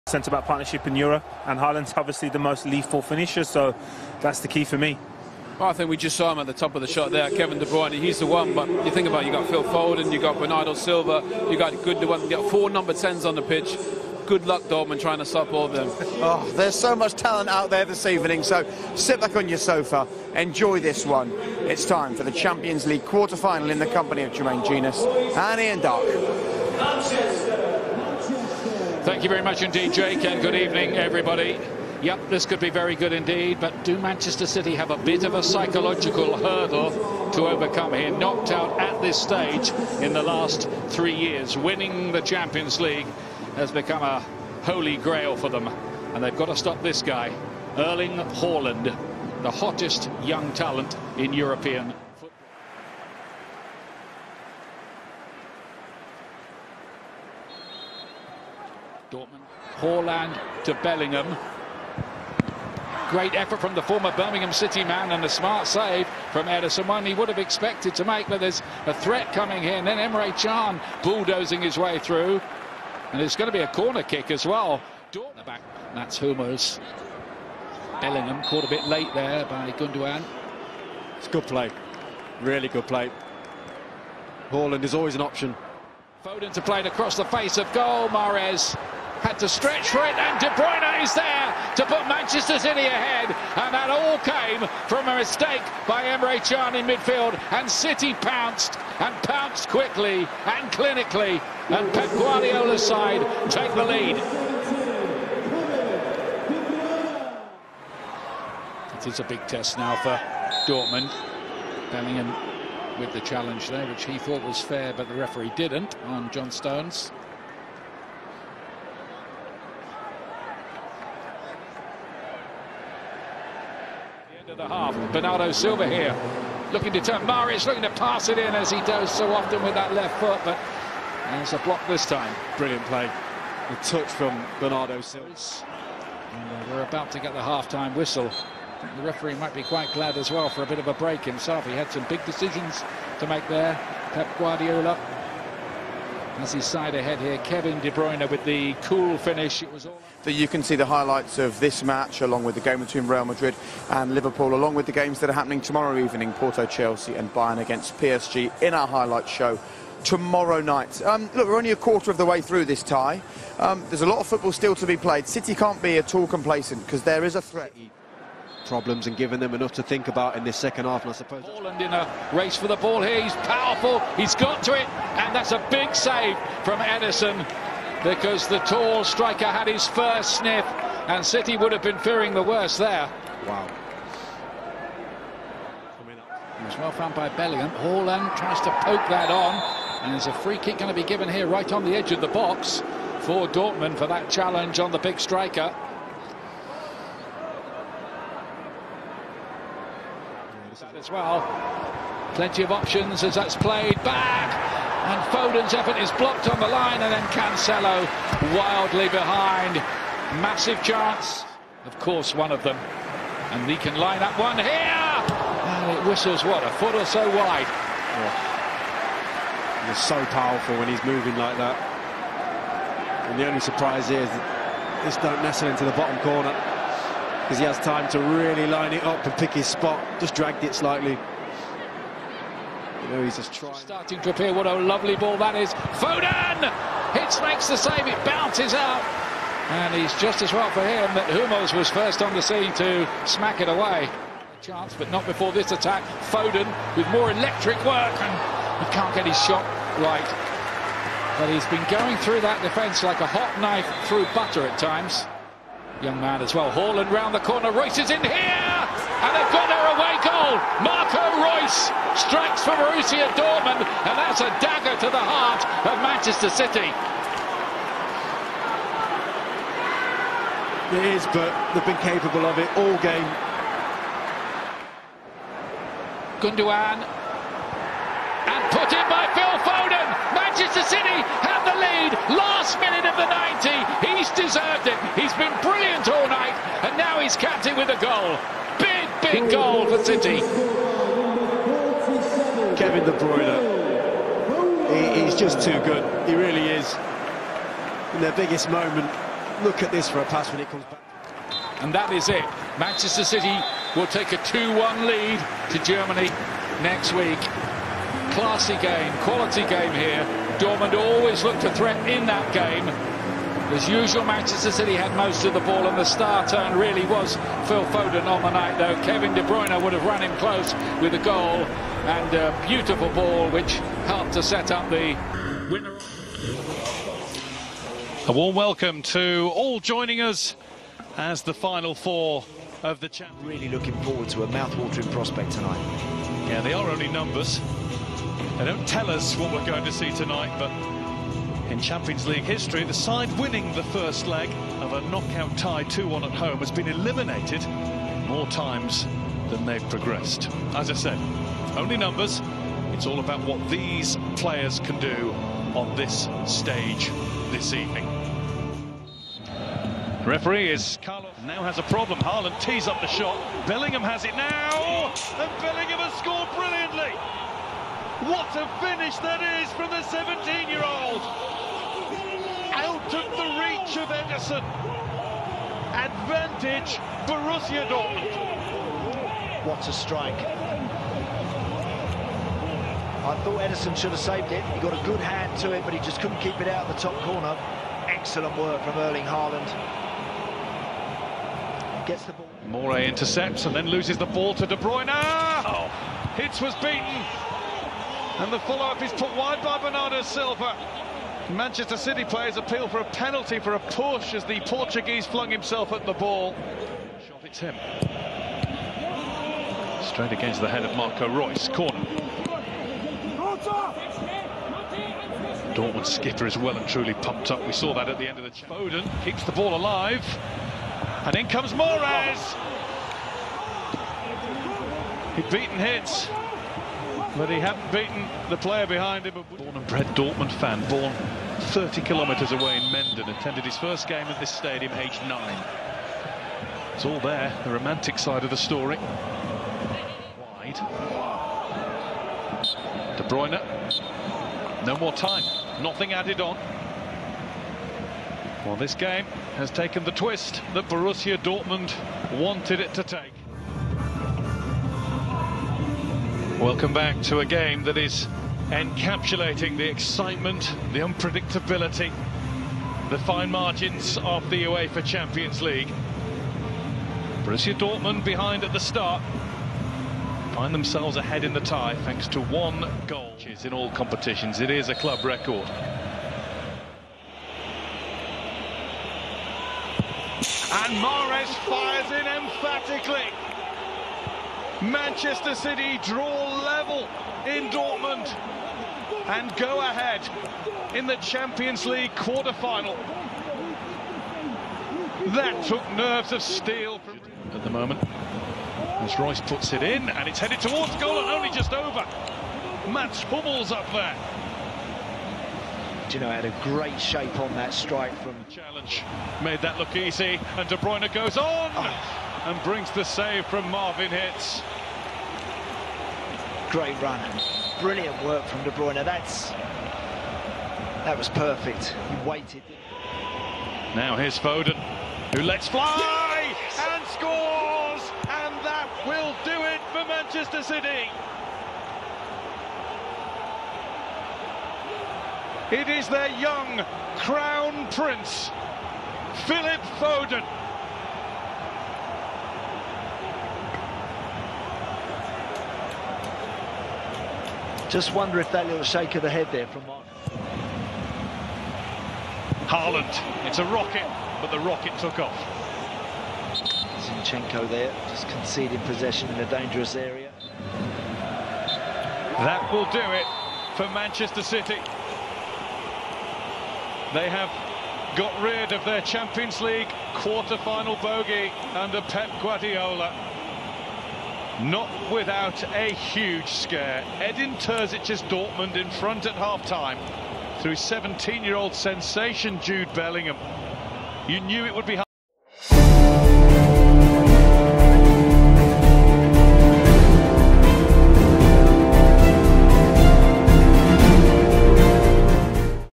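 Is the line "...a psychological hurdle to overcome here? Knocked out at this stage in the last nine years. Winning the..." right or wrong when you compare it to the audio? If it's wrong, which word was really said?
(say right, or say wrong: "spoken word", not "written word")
wrong: "three", not "nine".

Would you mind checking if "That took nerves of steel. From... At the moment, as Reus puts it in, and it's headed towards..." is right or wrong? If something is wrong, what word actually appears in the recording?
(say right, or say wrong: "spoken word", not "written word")
right.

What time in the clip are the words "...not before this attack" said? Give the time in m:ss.
4:05.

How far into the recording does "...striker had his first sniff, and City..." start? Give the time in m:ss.
2:59.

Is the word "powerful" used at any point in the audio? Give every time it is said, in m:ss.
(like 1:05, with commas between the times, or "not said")
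2:53, 3:40.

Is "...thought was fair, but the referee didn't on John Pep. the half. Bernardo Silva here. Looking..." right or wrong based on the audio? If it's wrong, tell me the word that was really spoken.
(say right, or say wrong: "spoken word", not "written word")
wrong: "Stones", not "Pep".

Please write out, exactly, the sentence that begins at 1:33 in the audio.
And that all came from a mistake by Emre Can in midfield.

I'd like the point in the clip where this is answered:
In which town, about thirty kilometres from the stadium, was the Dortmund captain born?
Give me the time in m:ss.
7:12.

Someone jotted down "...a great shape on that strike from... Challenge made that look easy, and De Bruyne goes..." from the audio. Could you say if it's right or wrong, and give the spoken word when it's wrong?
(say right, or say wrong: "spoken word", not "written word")
right.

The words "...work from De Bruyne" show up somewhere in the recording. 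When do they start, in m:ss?
8:38.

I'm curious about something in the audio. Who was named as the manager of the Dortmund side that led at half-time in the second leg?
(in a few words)
Edin Terzic.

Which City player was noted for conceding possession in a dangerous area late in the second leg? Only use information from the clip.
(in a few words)
Zinchenko.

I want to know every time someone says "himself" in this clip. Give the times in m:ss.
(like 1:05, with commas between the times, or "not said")
2:21, 6:45.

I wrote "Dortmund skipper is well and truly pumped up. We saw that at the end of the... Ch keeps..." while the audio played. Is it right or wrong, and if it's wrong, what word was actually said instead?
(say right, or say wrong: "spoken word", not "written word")
right.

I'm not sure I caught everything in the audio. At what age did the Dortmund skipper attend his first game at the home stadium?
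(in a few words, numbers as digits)
9.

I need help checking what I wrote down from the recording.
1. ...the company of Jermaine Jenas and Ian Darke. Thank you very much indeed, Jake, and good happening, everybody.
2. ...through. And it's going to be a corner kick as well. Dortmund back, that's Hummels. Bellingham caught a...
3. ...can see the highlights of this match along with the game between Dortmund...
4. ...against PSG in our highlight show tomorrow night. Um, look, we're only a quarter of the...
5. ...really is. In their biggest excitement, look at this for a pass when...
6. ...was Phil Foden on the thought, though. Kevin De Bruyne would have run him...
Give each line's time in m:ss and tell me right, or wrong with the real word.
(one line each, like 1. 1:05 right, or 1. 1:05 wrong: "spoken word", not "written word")
1. 0:23 wrong: "evening", not "happening"
2. 1:11 right
3. 2:30 wrong: "Real", not "Dortmund"
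4. 2:37 right
5. 4:56 wrong: "moment", not "excitement"
6. 5:17 wrong: "night", not "thought".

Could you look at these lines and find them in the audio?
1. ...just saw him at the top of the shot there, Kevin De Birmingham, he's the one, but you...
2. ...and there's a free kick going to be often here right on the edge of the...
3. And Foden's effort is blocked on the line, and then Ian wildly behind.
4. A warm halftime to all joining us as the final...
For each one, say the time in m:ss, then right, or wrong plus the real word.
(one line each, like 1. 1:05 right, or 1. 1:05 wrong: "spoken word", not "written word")
1. 0:05 wrong: "Bruyne", not "Birmingham"
2. 3:10 wrong: "given", not "often"
3. 3:25 wrong: "Cancelo", not "Ian"
4. 5:28 wrong: "welcome", not "halftime".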